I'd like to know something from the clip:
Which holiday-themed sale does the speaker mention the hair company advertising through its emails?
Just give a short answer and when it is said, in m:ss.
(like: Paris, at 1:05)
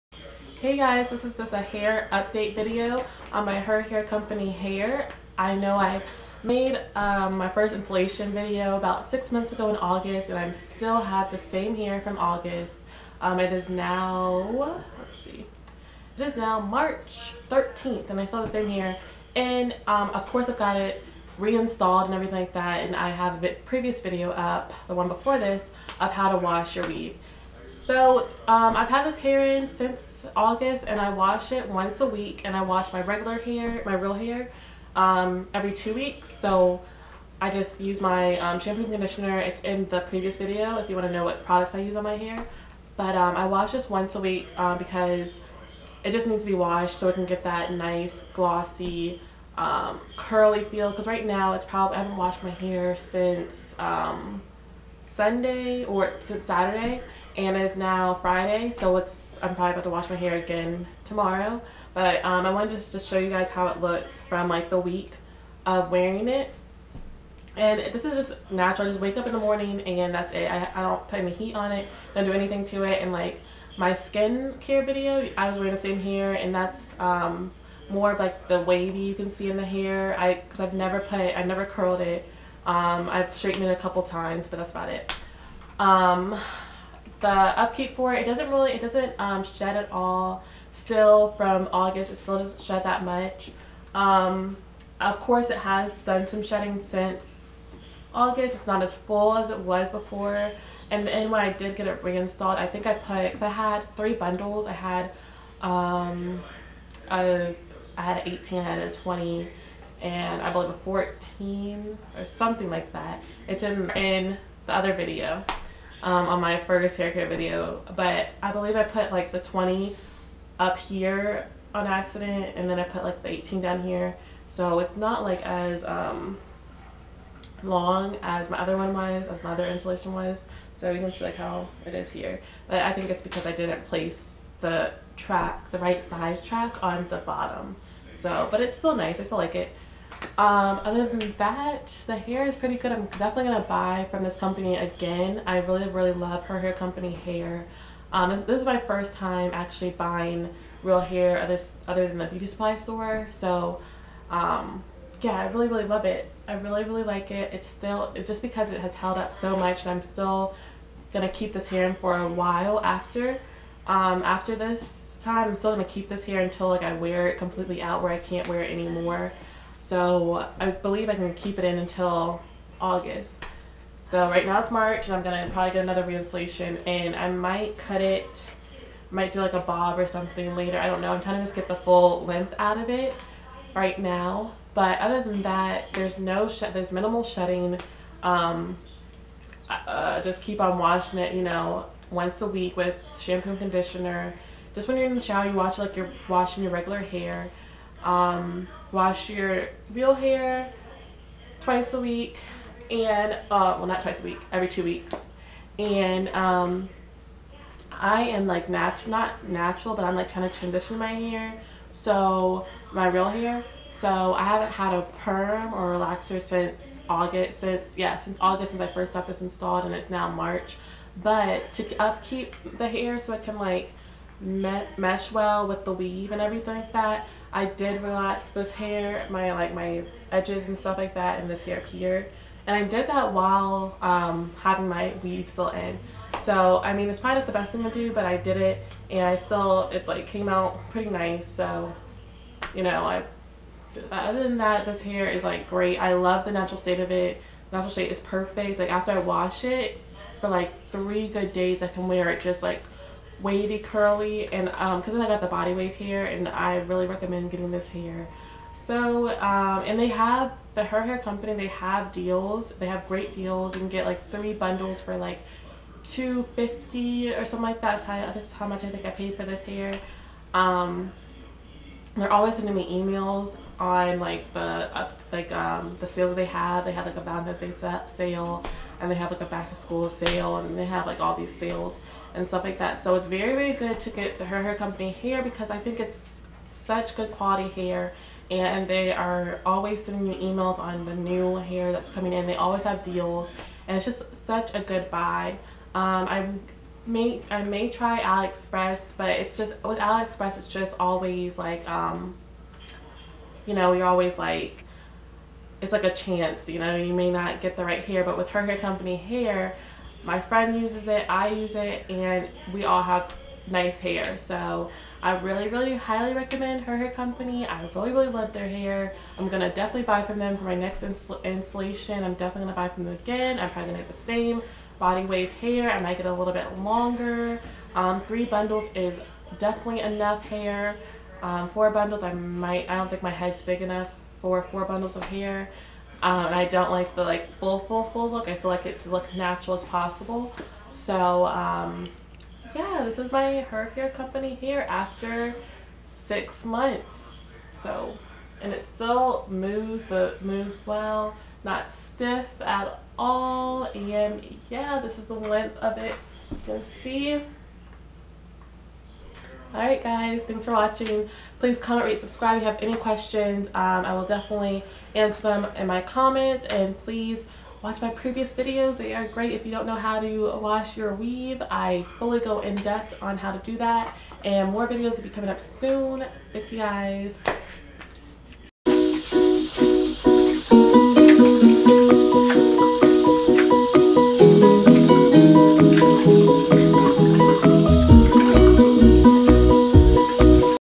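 Valentine's Day sale, at 4:37.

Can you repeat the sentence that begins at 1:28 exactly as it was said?
It doesn't really, it doesn't um, shed at all.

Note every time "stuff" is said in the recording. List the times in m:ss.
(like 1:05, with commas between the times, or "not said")
3:50, 4:42.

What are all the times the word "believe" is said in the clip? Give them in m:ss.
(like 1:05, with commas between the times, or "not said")
1:50, 1:58, 2:50.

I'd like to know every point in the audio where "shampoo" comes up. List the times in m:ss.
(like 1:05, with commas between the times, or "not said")
0:38, 3:13.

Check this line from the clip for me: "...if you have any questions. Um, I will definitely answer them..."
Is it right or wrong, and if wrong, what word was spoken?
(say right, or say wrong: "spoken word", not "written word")
right.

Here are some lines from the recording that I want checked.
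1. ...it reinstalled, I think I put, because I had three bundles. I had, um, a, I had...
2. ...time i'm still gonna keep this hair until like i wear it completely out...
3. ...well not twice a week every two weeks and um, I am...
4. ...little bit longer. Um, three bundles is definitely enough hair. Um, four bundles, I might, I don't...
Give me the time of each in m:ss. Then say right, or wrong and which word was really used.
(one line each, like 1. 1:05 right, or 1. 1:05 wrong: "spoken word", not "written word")
1. 1:41 right
2. 2:45 right
3. 3:23 right
4. 5:26 right.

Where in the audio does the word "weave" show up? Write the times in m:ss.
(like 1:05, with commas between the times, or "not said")
0:26, 3:45, 3:55, 6:11.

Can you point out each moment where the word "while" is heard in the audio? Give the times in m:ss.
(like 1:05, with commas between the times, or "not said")
2:42, 3:53.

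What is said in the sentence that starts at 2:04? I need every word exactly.
So it's not like as um, long as my other one was, as my other installation was.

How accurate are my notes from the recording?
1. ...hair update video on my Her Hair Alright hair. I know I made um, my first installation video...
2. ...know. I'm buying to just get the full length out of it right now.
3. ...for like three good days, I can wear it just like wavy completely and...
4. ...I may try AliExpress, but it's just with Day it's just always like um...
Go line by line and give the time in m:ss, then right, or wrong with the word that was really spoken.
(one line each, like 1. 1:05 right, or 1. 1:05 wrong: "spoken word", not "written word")
1. 0:01 wrong: "Company", not "Alright"
2. 3:01 wrong: "trying", not "buying"
3. 4:10 wrong: "curly", not "completely"
4. 4:57 wrong: "AliExpress", not "Day".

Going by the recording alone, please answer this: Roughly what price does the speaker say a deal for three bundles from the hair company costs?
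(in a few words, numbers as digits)
250.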